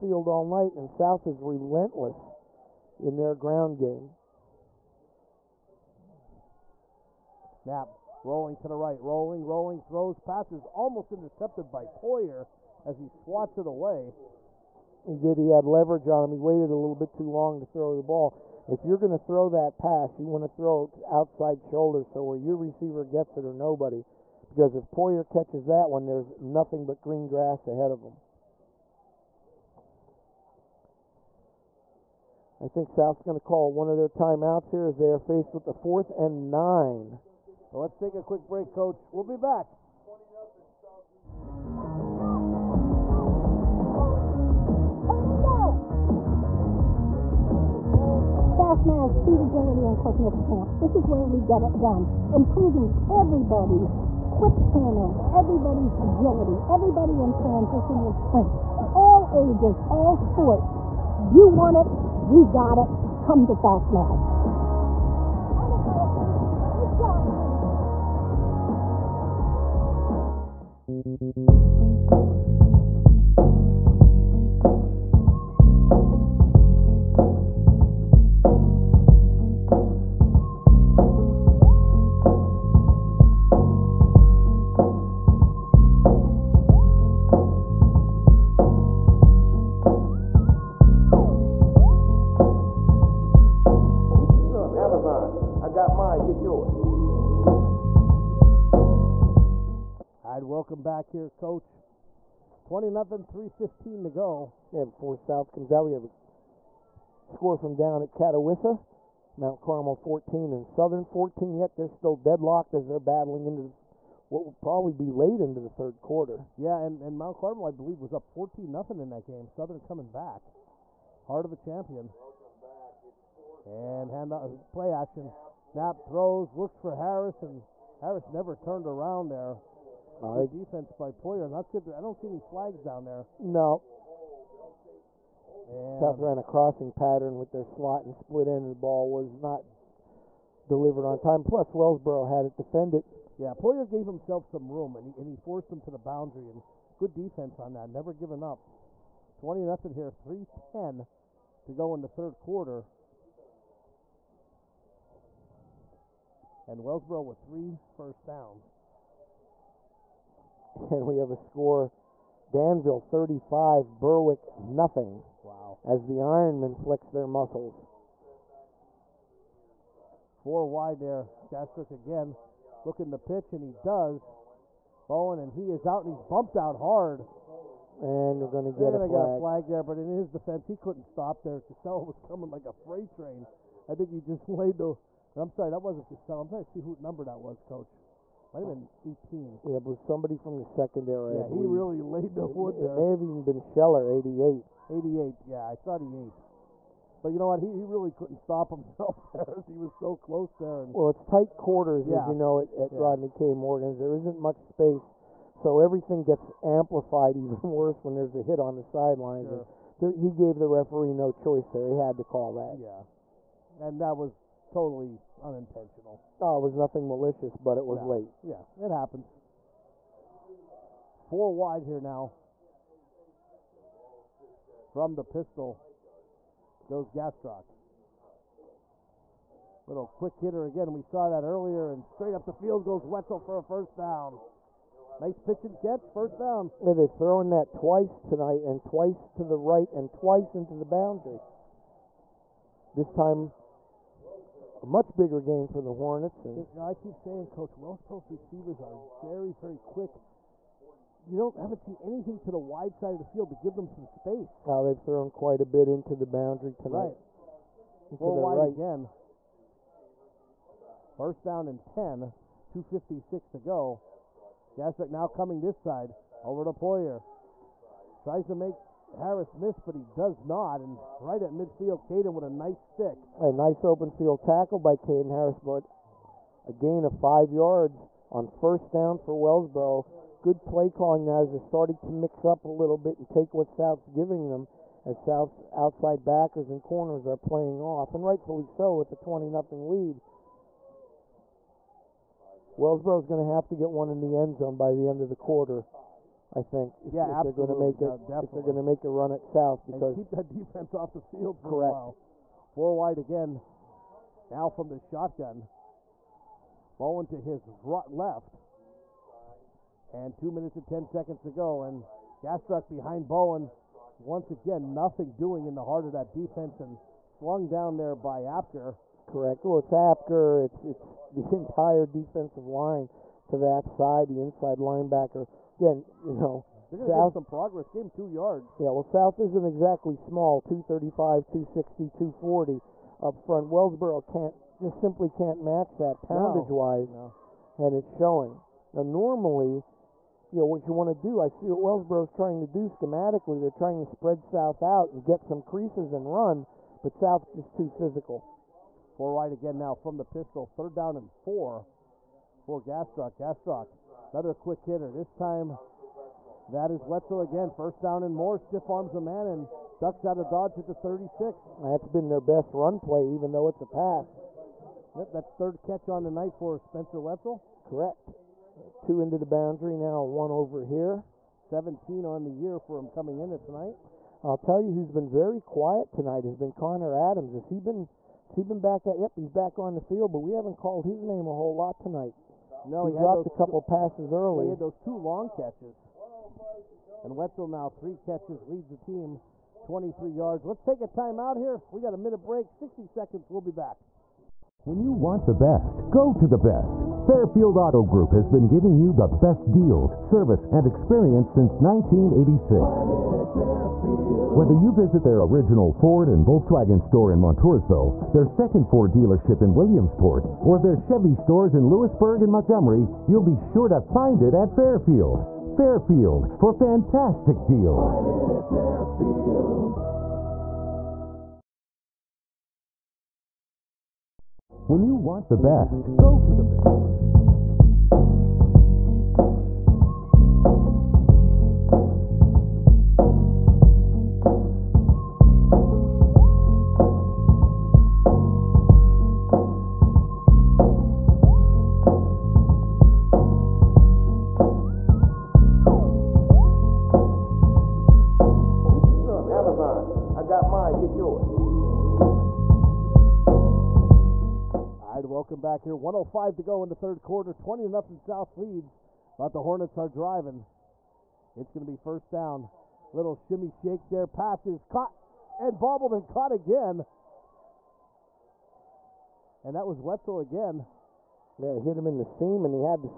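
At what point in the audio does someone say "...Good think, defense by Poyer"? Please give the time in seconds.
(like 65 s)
130 s.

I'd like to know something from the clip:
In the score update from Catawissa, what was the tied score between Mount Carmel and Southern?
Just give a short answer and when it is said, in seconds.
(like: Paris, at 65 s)
14-14, at 109 s.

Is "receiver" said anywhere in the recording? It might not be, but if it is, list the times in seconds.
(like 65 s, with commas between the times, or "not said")
22 s, 248 s.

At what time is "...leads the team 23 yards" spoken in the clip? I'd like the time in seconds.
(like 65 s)
388 s.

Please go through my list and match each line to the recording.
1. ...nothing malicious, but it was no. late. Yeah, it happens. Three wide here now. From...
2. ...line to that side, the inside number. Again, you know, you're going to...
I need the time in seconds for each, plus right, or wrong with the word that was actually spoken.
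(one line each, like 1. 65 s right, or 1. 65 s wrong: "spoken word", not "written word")
1. 216 s wrong: "Four", not "Three"
2. 322 s wrong: "linebacker", not "number".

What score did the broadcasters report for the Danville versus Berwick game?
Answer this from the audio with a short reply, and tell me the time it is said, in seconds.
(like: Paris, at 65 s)
35-0, at 162 s.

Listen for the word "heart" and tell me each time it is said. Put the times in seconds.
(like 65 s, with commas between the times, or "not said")
121 s, 315 s.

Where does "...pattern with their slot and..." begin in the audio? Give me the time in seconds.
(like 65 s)
136 s.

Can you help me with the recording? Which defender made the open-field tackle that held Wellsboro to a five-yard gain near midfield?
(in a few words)
Caden Harris.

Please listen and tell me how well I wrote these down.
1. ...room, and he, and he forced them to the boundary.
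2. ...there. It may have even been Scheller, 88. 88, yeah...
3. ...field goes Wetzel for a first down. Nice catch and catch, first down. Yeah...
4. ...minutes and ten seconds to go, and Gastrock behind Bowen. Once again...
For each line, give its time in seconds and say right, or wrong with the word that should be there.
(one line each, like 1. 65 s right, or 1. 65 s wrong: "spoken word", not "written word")
1. 144 s right
2. 192 s right
3. 232 s wrong: "pitch", not "catch"
4. 310 s right.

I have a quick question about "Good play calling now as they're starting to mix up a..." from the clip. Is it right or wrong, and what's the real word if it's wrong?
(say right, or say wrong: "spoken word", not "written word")
right.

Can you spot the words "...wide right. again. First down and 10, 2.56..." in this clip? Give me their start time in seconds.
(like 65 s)
258 s.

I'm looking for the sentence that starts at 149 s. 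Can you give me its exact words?
20 nothing here, 310 to go in the third quarter.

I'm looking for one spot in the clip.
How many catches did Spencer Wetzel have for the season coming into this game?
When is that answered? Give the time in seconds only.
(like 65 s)
371 s.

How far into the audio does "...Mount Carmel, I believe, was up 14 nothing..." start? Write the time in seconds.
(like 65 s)
117 s.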